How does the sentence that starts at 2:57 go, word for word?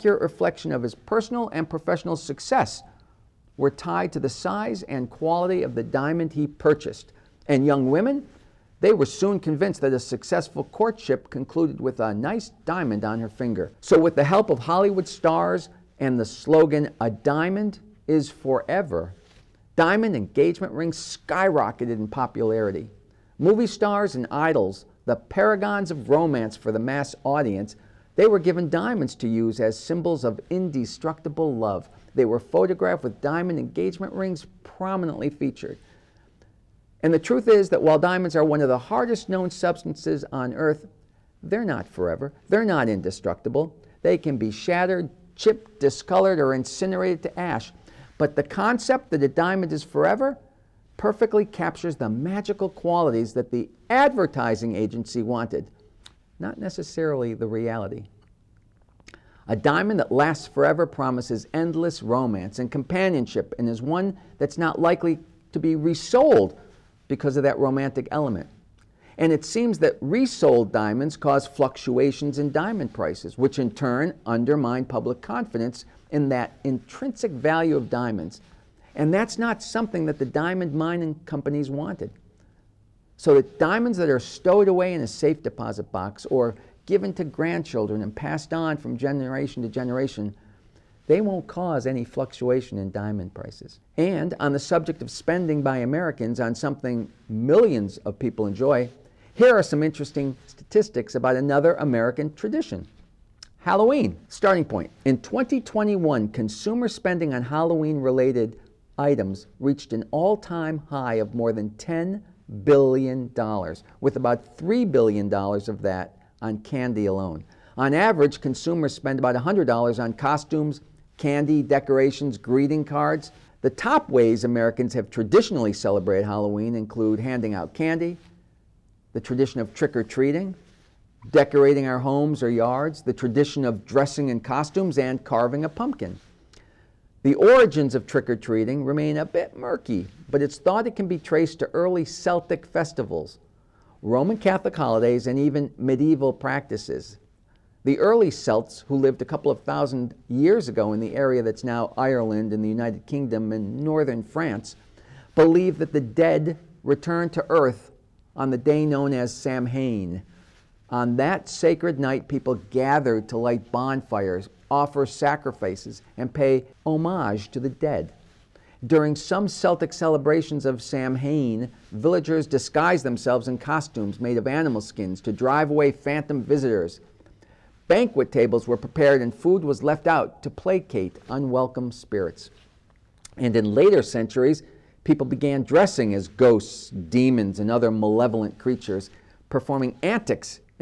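Banquet tables were prepared and food was left out to placate unwelcome spirits.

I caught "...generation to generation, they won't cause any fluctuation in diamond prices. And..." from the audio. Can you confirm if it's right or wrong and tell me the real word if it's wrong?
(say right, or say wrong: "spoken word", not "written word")
right.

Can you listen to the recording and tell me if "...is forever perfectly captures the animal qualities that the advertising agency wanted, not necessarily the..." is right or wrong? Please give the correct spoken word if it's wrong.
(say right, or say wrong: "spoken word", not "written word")
wrong: "magical", not "animal".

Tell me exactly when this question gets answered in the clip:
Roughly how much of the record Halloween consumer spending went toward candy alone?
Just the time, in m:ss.
1:54.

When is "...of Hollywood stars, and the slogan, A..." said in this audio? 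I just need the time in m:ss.
0:14.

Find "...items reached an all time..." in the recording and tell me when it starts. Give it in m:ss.
1:48.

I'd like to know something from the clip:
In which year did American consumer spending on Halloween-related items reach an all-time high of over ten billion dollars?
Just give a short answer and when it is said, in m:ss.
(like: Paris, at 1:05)
2021, at 1:45.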